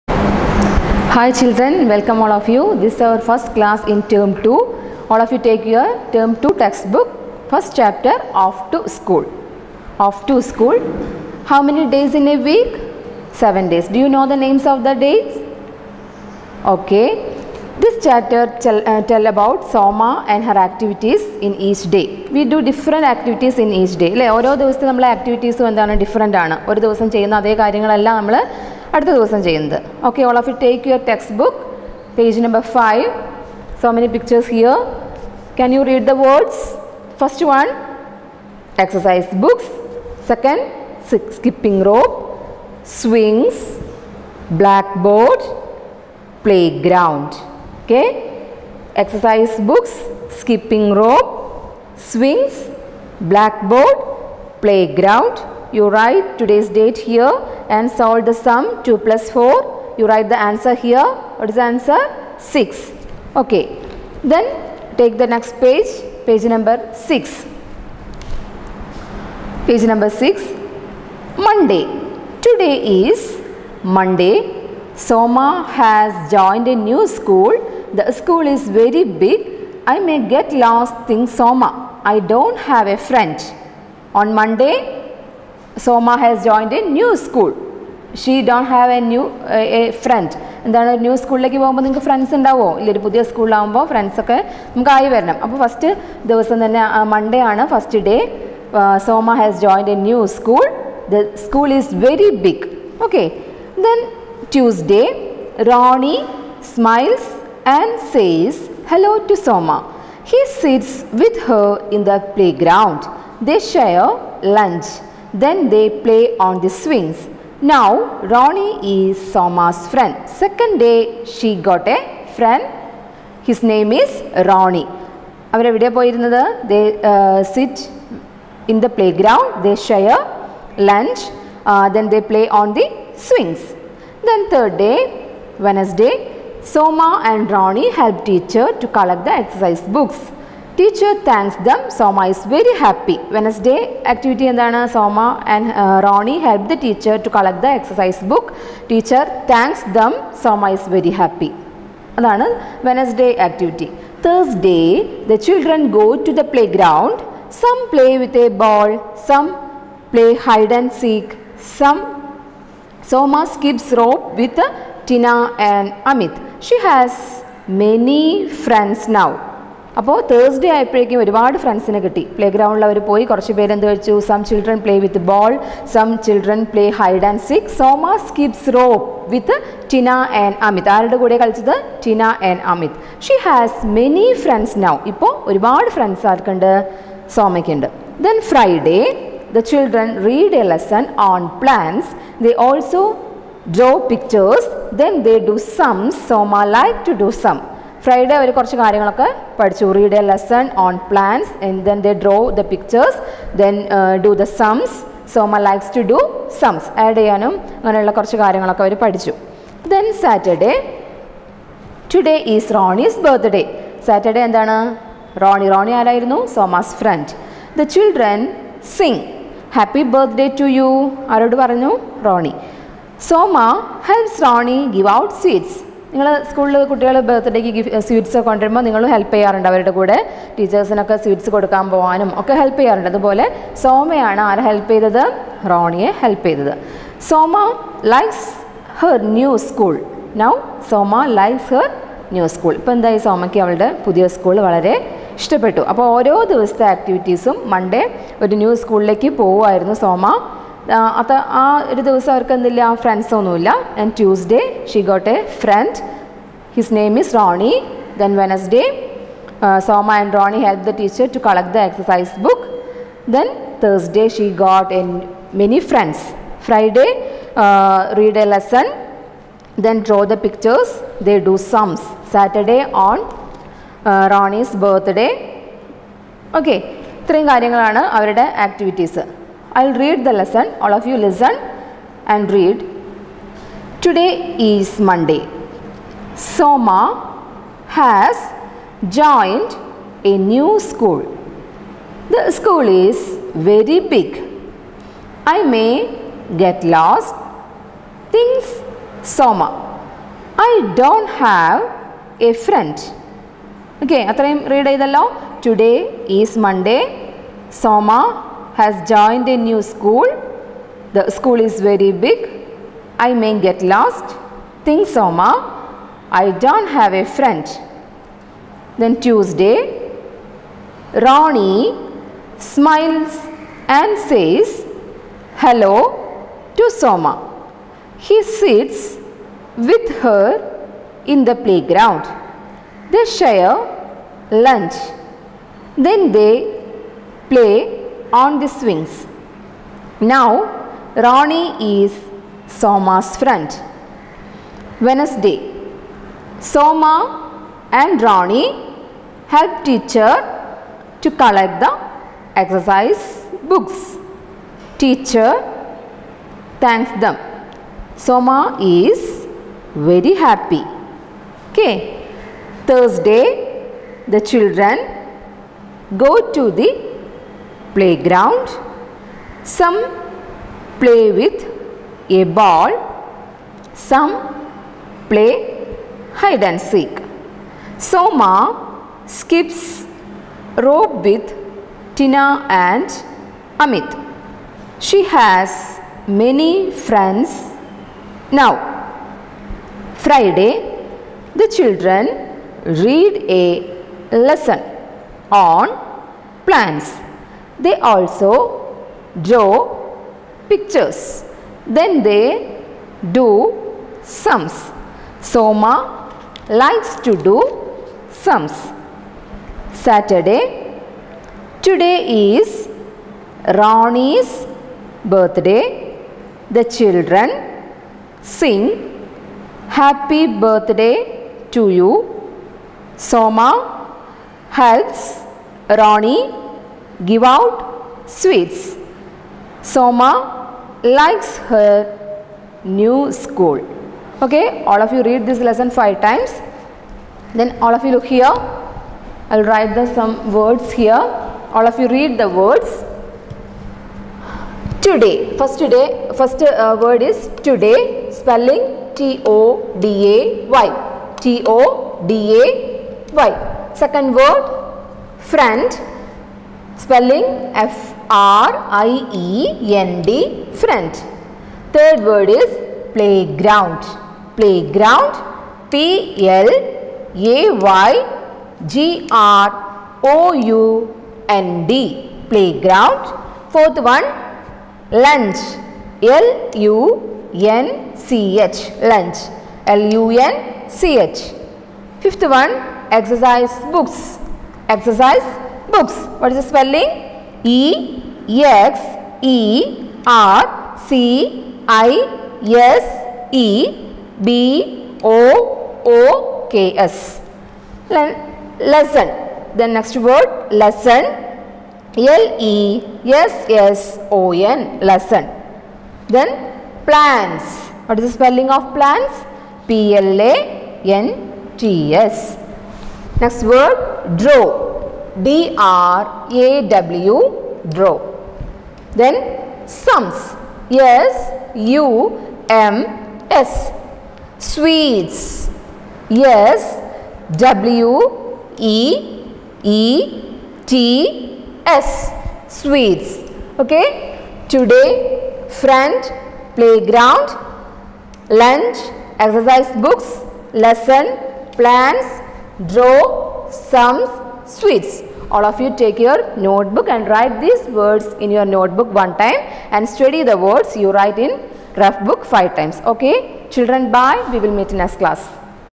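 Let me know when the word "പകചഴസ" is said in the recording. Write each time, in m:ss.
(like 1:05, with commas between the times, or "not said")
0:34, 3:14, 3:22, 4:30.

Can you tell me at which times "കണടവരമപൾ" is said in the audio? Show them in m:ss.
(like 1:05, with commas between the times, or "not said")
3:48.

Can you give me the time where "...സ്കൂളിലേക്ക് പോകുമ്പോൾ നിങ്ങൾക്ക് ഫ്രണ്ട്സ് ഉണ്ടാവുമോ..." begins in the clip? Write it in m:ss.
1:31.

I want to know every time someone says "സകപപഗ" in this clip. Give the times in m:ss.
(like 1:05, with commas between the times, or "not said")
0:41, 0:50.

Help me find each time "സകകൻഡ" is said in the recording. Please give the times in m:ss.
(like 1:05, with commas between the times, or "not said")
0:40.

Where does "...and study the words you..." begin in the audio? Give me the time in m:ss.
9:09.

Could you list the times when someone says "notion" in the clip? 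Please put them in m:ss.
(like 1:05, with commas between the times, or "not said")
not said.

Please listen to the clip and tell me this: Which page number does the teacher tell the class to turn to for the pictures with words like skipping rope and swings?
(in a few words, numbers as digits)
5.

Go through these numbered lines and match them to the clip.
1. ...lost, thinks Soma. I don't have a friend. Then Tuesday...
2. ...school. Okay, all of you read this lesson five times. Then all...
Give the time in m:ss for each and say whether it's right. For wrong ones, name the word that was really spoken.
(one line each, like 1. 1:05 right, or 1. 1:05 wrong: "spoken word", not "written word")
1. 5:13 right
2. 7:13 right.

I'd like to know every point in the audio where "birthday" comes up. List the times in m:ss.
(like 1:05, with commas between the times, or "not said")
6:55, 7:00.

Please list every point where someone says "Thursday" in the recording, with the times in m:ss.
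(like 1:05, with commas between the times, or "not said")
2:34, 6:02.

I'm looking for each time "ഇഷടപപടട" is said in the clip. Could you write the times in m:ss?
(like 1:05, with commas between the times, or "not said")
4:05.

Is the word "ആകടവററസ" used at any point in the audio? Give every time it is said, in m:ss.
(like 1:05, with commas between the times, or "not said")
0:25, 4:06, 4:38.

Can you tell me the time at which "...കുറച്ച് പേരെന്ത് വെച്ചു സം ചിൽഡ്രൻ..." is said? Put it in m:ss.
2:53.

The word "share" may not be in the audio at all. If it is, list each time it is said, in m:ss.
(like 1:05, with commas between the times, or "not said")
5:33.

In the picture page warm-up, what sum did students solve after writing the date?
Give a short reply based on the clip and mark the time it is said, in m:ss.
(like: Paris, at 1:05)
2 plus 4, at 0:58.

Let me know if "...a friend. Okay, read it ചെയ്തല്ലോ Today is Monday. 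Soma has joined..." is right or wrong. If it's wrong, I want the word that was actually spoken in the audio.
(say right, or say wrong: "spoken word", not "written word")
right.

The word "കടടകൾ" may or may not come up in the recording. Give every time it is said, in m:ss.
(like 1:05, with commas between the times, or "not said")
3:46.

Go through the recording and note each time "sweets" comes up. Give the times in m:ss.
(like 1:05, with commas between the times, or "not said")
7:08, 8:44, 8:52, 9:04.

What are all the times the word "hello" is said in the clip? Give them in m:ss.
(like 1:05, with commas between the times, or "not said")
5:25.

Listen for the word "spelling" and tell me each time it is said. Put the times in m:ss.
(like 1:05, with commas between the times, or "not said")
7:28, 7:37, 8:06, 8:28.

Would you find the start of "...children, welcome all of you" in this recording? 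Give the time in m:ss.
0:01.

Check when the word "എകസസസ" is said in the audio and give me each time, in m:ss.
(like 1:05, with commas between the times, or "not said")
0:38, 0:49, 4:21.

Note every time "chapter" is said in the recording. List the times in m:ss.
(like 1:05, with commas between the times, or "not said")
0:07, 0:18.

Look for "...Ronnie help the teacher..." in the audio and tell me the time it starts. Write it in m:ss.
2:26.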